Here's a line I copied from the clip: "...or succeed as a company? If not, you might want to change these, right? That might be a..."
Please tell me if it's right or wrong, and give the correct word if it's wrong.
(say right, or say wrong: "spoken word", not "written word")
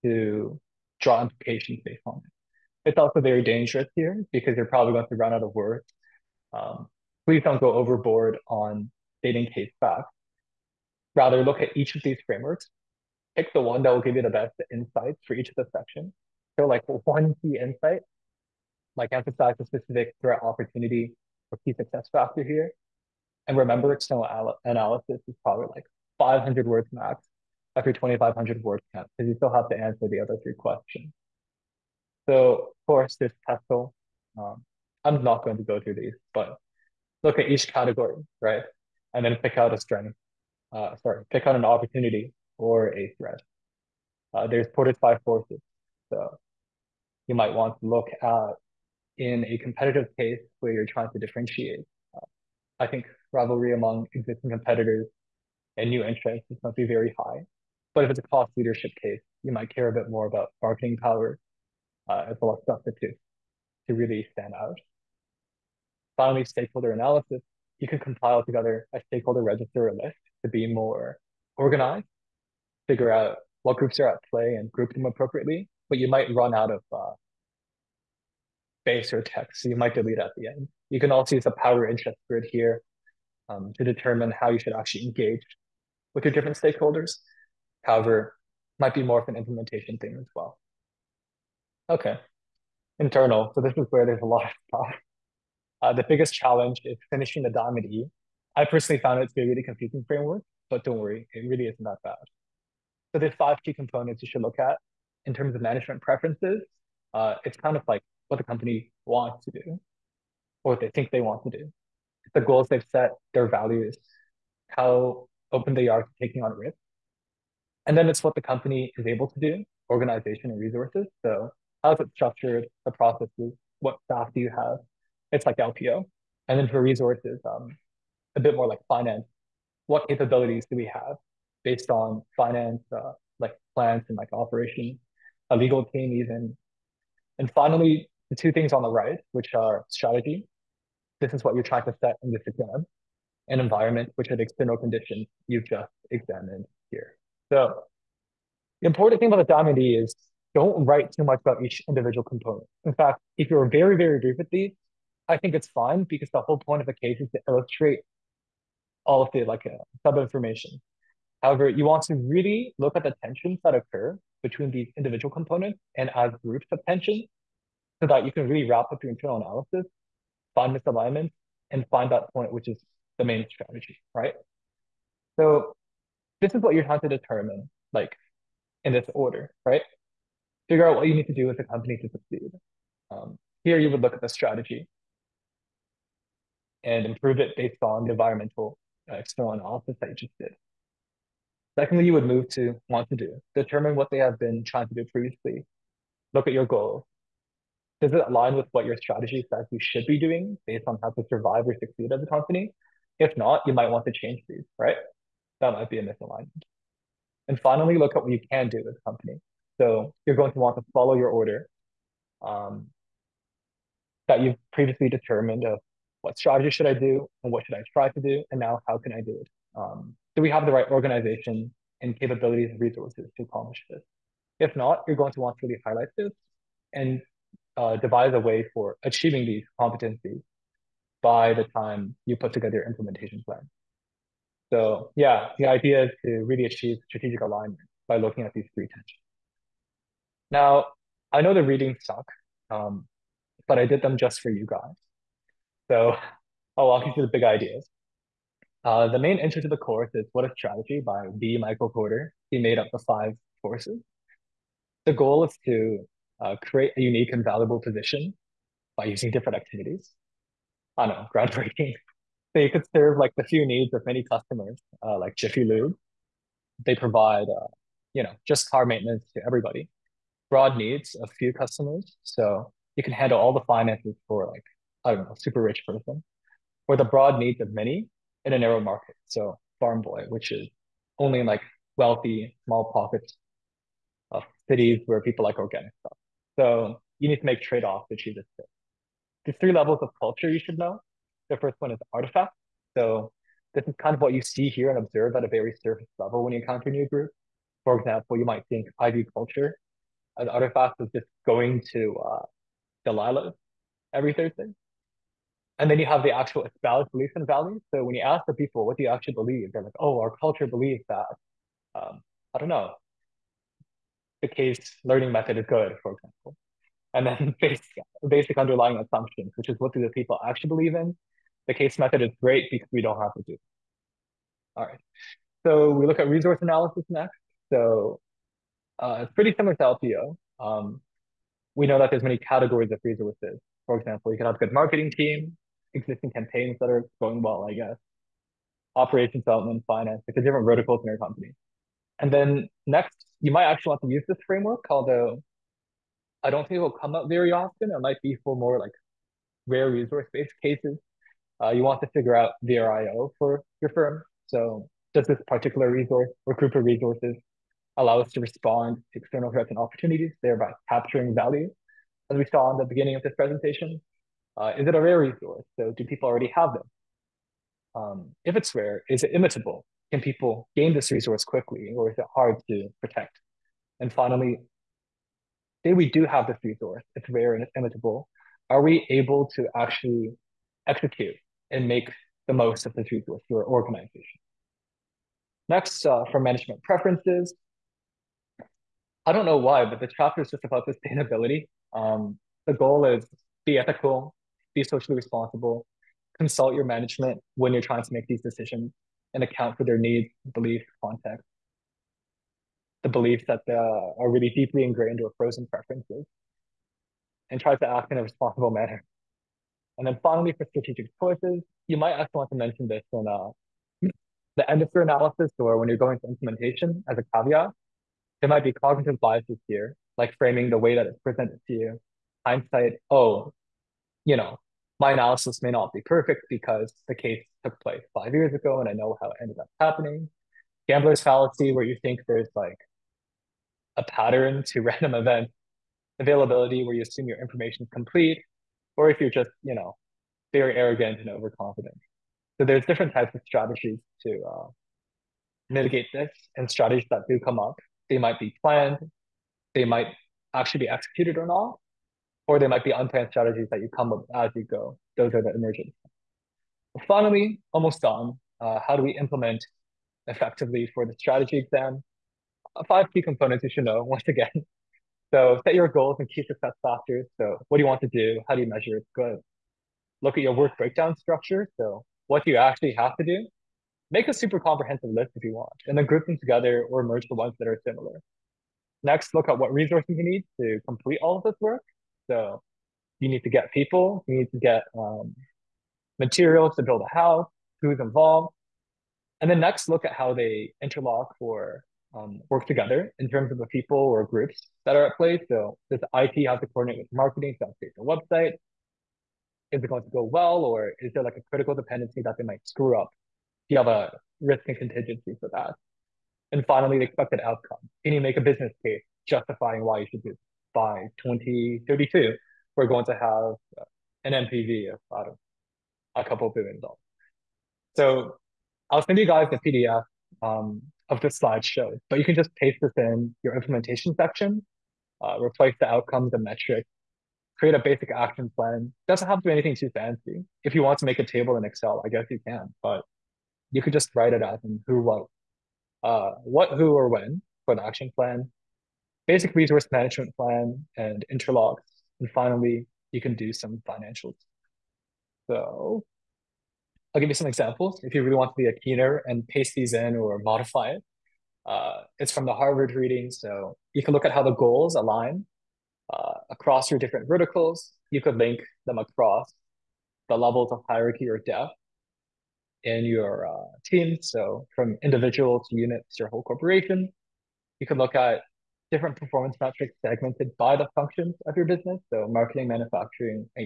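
right.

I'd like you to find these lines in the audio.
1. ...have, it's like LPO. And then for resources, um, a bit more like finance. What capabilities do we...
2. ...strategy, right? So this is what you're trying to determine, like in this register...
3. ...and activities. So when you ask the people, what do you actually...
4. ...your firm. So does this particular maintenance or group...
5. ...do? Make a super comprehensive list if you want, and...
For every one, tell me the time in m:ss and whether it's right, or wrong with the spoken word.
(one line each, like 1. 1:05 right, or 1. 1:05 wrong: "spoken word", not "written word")
1. 2:04 right
2. 2:53 wrong: "order", not "register"
3. 5:07 wrong: "values", not "activities"
4. 5:53 wrong: "resource", not "maintenance"
5. 7:53 right.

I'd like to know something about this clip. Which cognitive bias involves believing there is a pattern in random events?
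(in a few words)
Gambler's fallacy.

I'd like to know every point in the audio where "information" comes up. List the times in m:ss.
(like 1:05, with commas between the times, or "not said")
2:40, 7:17.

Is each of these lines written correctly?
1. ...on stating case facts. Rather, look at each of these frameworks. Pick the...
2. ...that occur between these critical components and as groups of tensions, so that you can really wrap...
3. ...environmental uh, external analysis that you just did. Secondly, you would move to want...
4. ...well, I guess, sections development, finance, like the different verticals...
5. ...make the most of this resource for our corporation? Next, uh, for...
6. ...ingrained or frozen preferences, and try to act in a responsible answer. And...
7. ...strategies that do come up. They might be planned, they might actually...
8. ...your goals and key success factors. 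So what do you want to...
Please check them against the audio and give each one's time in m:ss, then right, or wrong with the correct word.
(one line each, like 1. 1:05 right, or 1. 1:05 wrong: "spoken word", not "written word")
1. 0:08 right
2. 2:43 wrong: "individual", not "critical"
3. 3:08 right
4. 5:37 wrong: "operations", not "sections"
5. 6:21 wrong: "organization", not "corporation"
6. 6:44 wrong: "manner", not "answer"
7. 7:26 right
8. 7:45 right.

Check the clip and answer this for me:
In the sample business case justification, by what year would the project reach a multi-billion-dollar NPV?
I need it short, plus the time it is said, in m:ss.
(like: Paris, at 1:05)
2032, at 8:31.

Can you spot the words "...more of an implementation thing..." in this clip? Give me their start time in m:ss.
1:29.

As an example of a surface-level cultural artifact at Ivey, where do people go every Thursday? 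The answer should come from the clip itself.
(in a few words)
Delilah.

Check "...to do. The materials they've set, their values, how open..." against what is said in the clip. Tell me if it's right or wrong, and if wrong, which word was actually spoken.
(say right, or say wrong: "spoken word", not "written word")
wrong: "goals", not "materials".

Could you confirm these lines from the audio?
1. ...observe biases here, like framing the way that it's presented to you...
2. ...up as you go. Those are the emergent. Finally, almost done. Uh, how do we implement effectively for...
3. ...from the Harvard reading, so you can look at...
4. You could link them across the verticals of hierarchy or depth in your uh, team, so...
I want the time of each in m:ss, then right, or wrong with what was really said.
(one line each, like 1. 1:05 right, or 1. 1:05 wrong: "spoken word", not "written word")
1. 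6:58 wrong: "cognitive", not "observe"
2. 7:34 right
3. 9:12 right
4. 9:18 wrong: "levels", not "verticals".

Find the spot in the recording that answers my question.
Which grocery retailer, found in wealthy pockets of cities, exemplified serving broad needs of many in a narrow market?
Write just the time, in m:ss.
4:39.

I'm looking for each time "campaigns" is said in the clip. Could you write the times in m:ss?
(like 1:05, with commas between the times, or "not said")
5:36.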